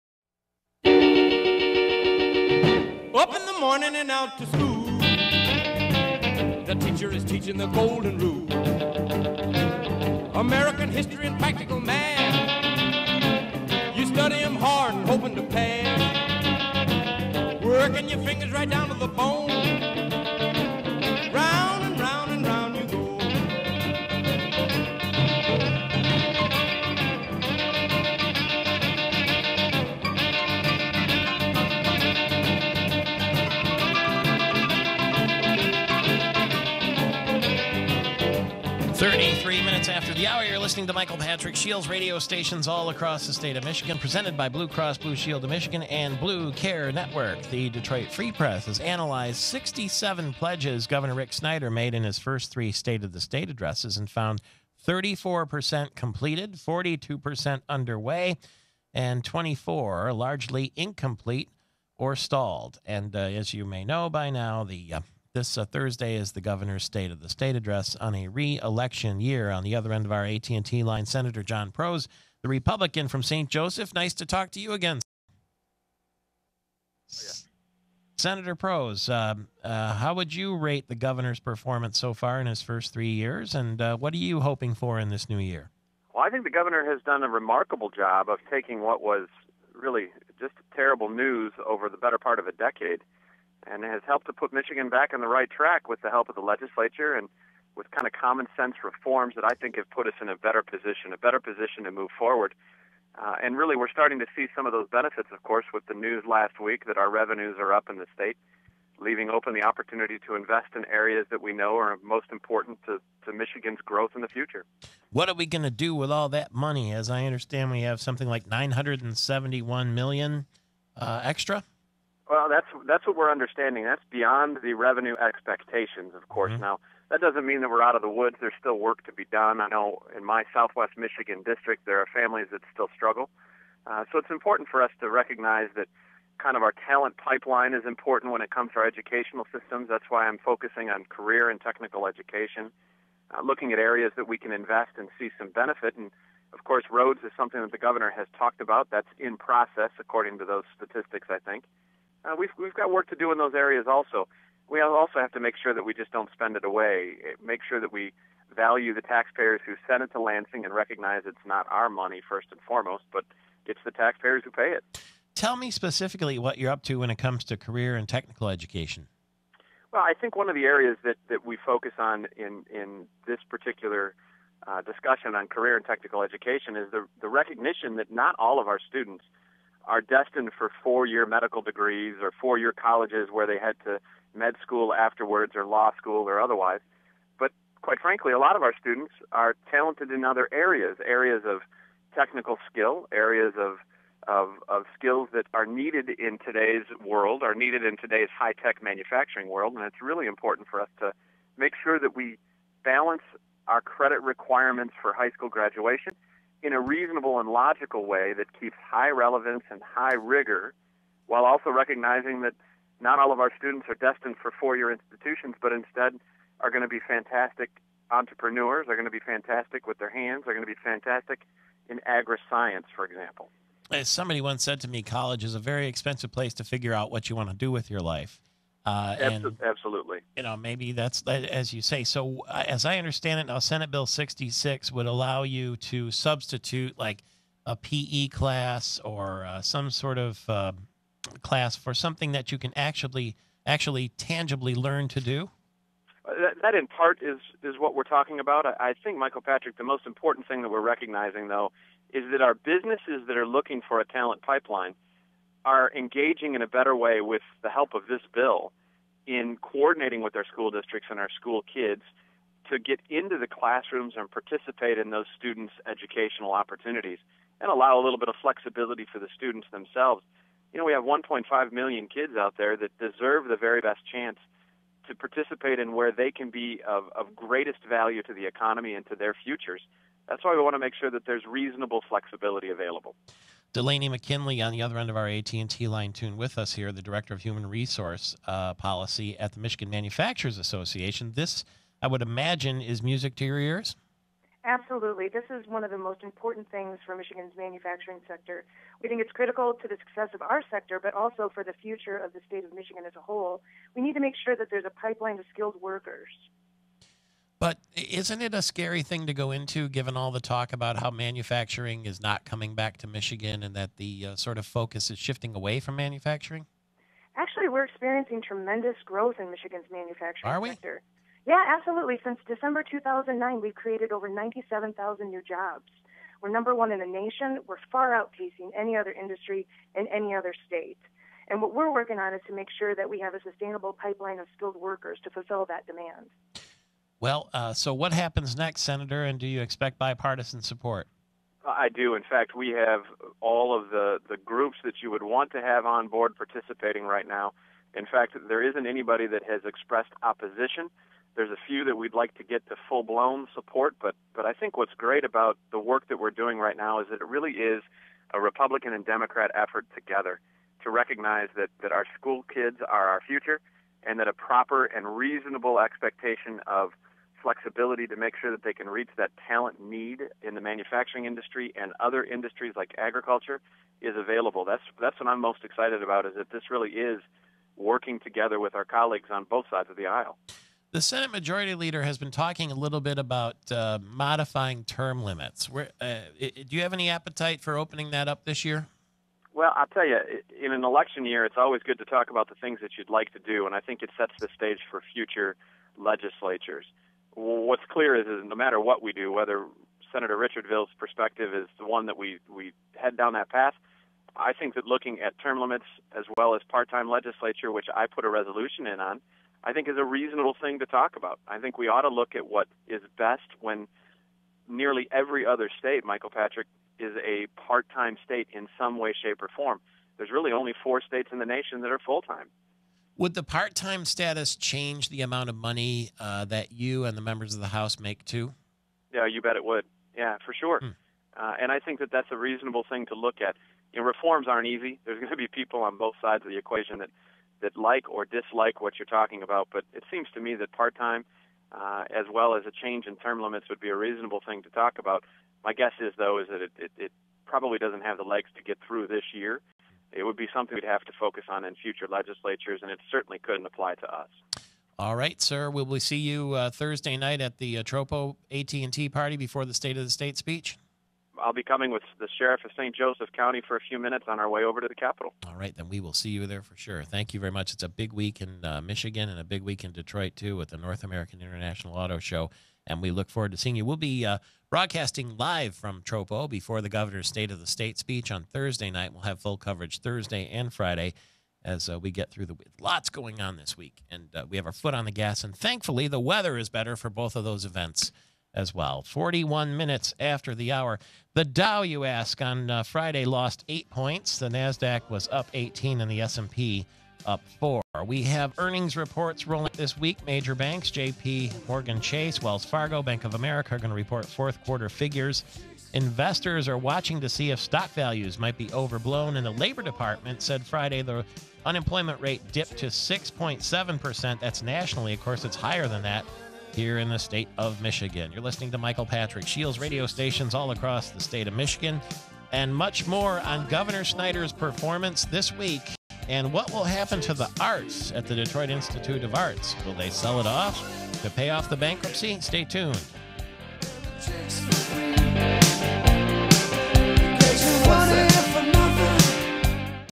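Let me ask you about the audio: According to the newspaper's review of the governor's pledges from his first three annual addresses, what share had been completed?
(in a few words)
34%.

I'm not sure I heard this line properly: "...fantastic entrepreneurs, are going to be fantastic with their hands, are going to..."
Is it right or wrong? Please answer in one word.
right.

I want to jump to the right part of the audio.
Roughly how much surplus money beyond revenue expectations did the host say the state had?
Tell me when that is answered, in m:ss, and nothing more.
1:58.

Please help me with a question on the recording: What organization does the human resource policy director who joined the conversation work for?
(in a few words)
Michigan Manufacturers Association.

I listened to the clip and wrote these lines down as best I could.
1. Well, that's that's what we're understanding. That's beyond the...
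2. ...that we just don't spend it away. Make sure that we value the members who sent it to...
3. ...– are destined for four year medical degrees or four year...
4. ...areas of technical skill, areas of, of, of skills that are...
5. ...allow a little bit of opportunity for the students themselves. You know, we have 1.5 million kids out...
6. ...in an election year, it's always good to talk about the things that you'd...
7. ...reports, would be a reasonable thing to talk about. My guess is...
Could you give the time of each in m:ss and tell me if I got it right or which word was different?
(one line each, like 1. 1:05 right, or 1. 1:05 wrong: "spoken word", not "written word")
1. 2:02 right
2. 2:35 wrong: "taxpayers", not "members"
3. 2:59 right
4. 3:11 right
5. 4:27 wrong: "flexibility", not "opportunity"
6. 6:30 right
7. 7:23 wrong: "limits", not "reports".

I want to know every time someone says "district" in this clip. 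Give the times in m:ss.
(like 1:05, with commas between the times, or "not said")
2:11, 4:20.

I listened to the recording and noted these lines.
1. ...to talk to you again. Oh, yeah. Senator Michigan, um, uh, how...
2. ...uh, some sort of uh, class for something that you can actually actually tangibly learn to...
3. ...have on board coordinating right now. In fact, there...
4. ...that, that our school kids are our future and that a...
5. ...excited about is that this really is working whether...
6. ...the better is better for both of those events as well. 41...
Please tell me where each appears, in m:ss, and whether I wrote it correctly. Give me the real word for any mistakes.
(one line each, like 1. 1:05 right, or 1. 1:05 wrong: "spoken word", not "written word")
1. 1:14 wrong: "Proos", not "Michigan"
2. 3:59 right
3. 5:45 wrong: "participating", not "coordinating"
4. 6:01 right
5. 6:15 wrong: "together", not "whether"
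6. 8:06 wrong: "weather", not "better".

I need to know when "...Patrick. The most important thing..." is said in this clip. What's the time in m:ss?
4:09.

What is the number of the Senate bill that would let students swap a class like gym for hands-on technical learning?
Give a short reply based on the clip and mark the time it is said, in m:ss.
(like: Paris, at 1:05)
Senate Bill 66, at 3:53.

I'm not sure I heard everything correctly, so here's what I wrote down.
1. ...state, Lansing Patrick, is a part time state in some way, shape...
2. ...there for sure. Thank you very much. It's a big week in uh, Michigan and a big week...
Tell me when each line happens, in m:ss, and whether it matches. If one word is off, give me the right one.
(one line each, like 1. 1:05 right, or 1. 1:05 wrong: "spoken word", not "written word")
1. 6:55 wrong: "Michael", not "Lansing"
2. 7:46 right.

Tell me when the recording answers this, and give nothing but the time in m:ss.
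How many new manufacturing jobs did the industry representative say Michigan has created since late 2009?
5:24.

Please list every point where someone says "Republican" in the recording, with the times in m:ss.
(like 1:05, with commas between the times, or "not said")
1:12, 5:58.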